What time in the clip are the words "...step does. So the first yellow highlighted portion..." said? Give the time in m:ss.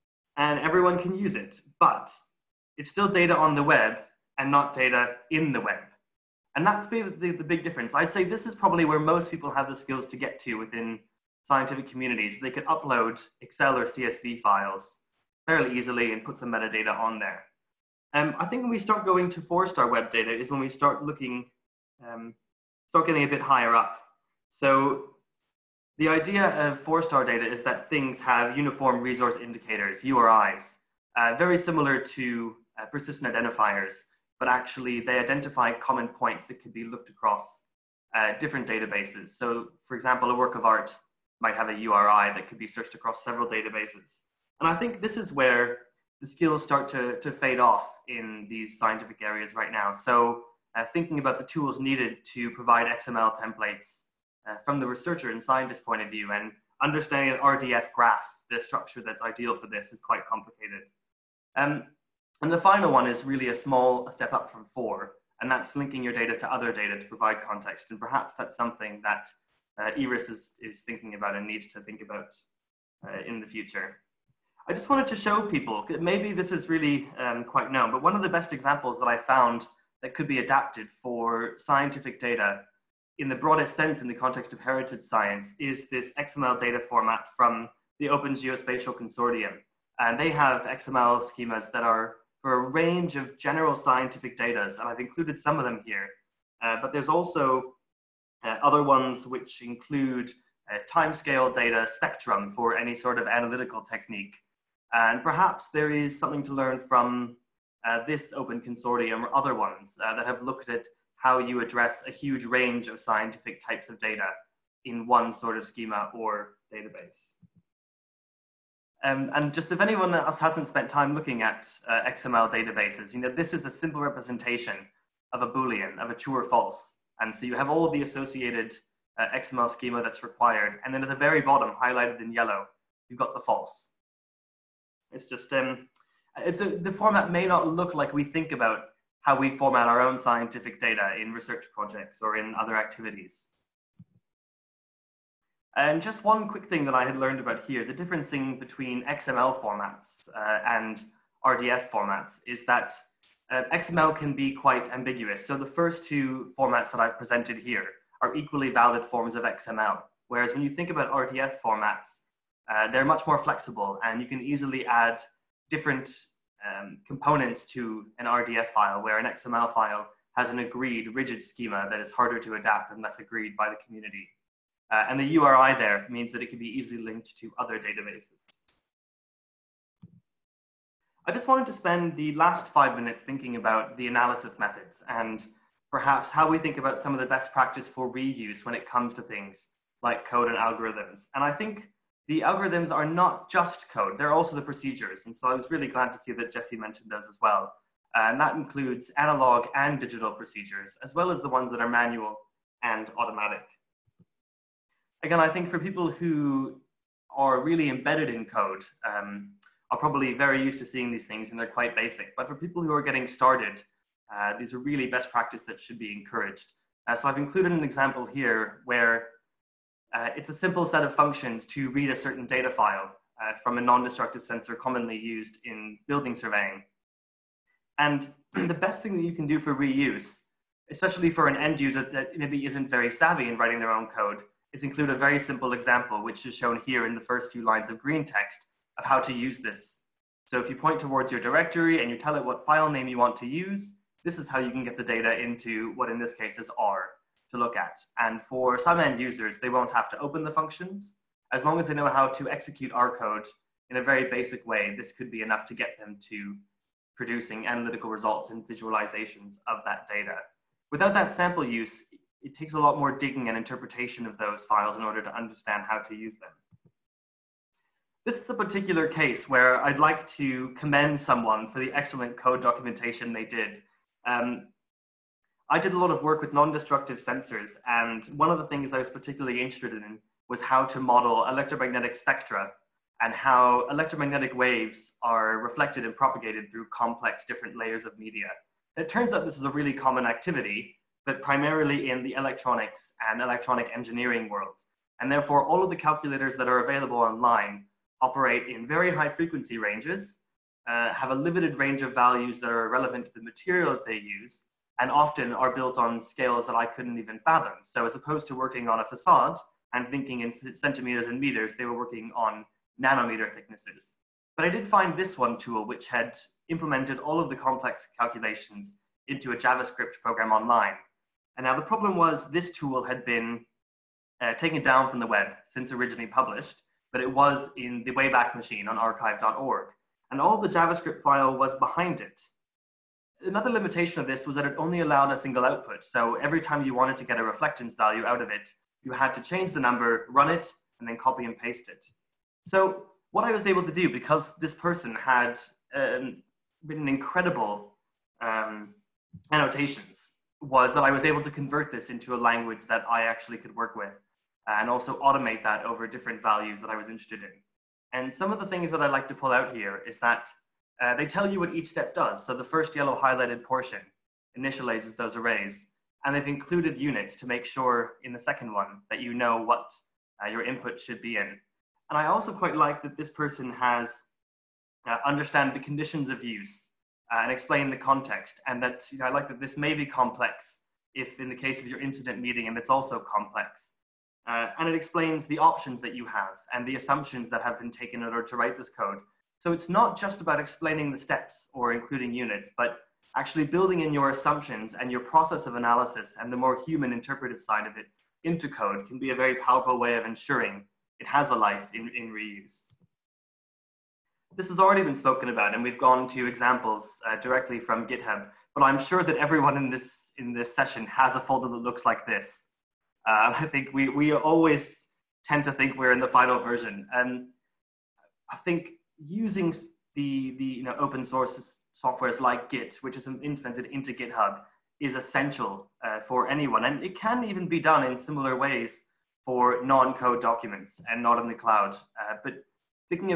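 6:01.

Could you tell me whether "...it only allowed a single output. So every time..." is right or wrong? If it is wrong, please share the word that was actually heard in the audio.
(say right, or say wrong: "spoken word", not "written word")
right.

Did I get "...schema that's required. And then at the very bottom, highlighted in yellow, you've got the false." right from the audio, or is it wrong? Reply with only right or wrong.
right.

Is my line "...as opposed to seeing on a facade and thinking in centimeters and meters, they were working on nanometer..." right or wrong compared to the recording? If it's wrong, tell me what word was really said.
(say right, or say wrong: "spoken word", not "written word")
wrong: "working", not "seeing".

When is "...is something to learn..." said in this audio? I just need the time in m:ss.
1:45.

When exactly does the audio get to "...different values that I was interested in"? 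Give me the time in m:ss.
5:56.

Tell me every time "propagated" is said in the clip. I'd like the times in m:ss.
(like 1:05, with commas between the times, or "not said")
4:46.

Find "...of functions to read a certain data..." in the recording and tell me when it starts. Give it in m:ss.
3:41.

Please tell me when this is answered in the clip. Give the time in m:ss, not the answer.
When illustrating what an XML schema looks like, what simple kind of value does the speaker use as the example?
2:05.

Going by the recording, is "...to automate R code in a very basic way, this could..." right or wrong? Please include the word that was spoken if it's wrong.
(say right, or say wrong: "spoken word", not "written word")
wrong: "execute", not "automate".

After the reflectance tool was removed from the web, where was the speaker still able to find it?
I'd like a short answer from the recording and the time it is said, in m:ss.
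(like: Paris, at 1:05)
The Wayback Machine, at 5:28.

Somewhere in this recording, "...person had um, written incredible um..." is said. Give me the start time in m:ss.
5:44.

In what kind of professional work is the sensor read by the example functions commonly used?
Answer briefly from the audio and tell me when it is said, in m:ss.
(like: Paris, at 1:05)
Building surveying, at 3:46.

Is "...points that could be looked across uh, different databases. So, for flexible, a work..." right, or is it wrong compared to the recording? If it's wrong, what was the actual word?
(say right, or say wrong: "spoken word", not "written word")
wrong: "example", not "flexible".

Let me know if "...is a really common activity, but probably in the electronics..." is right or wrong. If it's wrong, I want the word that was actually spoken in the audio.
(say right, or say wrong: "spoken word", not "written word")
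wrong: "primarily", not "probably".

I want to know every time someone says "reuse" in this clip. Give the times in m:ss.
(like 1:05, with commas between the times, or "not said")
3:08, 3:49, 6:42.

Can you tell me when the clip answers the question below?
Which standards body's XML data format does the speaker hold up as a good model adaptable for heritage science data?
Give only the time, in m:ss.
1:28.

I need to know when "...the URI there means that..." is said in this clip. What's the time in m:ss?
2:55.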